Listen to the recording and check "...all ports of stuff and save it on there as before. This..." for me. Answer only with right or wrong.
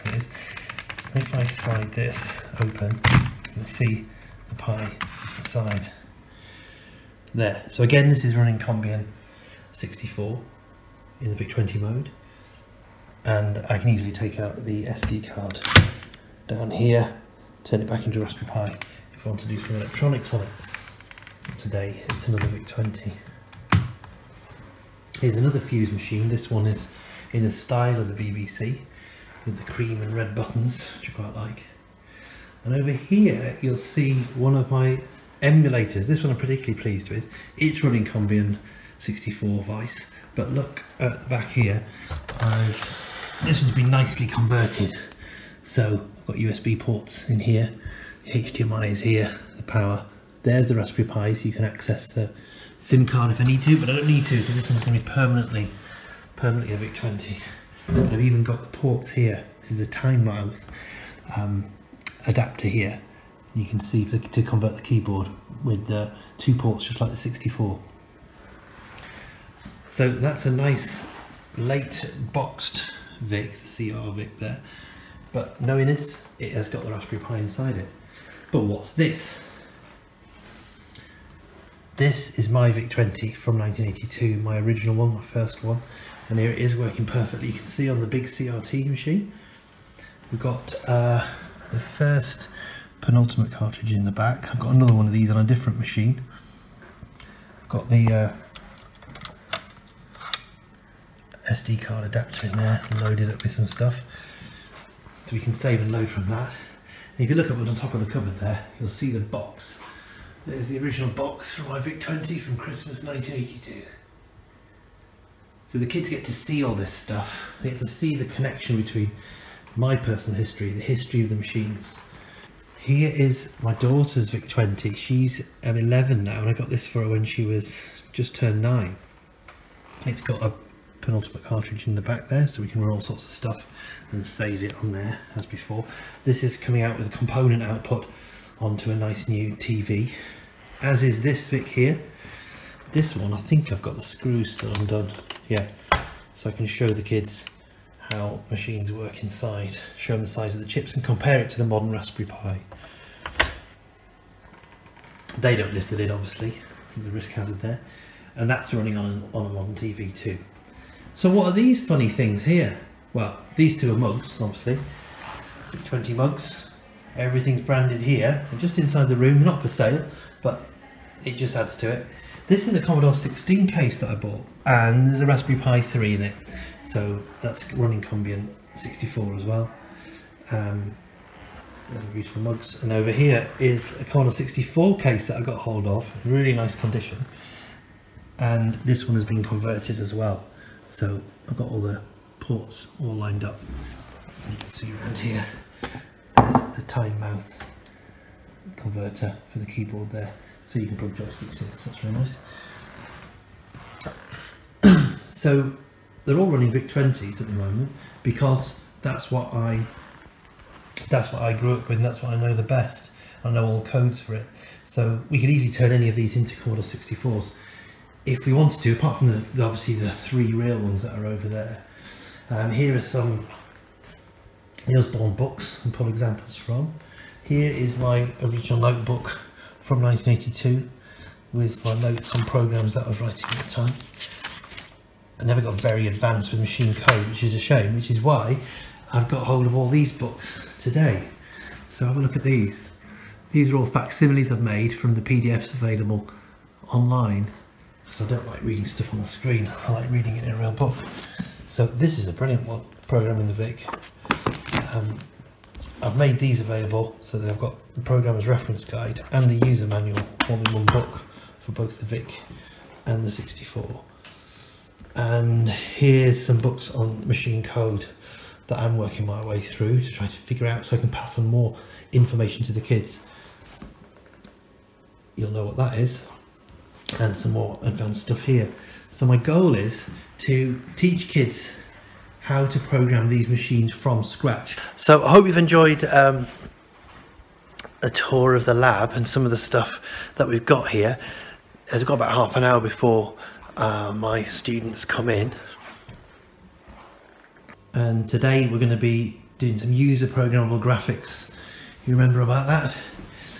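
wrong.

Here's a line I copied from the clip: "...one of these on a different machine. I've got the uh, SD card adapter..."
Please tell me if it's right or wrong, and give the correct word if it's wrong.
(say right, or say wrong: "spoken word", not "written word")
right.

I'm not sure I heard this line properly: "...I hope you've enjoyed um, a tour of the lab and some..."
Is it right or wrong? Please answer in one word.
right.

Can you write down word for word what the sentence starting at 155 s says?
They don't lift the lid obviously the risk hazard there and that's running on, on a modern TV too.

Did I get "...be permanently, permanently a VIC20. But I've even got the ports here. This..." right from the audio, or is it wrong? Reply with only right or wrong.
right.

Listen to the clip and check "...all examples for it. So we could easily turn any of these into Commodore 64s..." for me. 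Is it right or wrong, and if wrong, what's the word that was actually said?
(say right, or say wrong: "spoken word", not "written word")
wrong: "codes", not "examples".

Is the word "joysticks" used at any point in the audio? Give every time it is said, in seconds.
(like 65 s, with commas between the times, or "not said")
201 s.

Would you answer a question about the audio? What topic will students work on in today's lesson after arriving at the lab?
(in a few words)
User programmable graphics.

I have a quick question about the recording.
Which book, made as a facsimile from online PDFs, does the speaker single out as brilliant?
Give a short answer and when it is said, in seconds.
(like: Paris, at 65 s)
Programming the Vic, at 253 s.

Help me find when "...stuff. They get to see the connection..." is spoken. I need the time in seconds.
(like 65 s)
116 s.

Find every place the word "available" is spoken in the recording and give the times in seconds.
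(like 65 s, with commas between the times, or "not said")
245 s, 256 s.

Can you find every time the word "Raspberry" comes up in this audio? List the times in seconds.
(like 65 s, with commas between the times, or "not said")
18 s, 50 s, 76 s, 151 s, 175 s.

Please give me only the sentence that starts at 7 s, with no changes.
So again, this is running Combian 64 in the VIC-20 mode.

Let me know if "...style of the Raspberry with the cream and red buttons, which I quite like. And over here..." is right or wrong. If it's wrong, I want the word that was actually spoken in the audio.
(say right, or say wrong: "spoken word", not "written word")
wrong: "BBC", not "Raspberry".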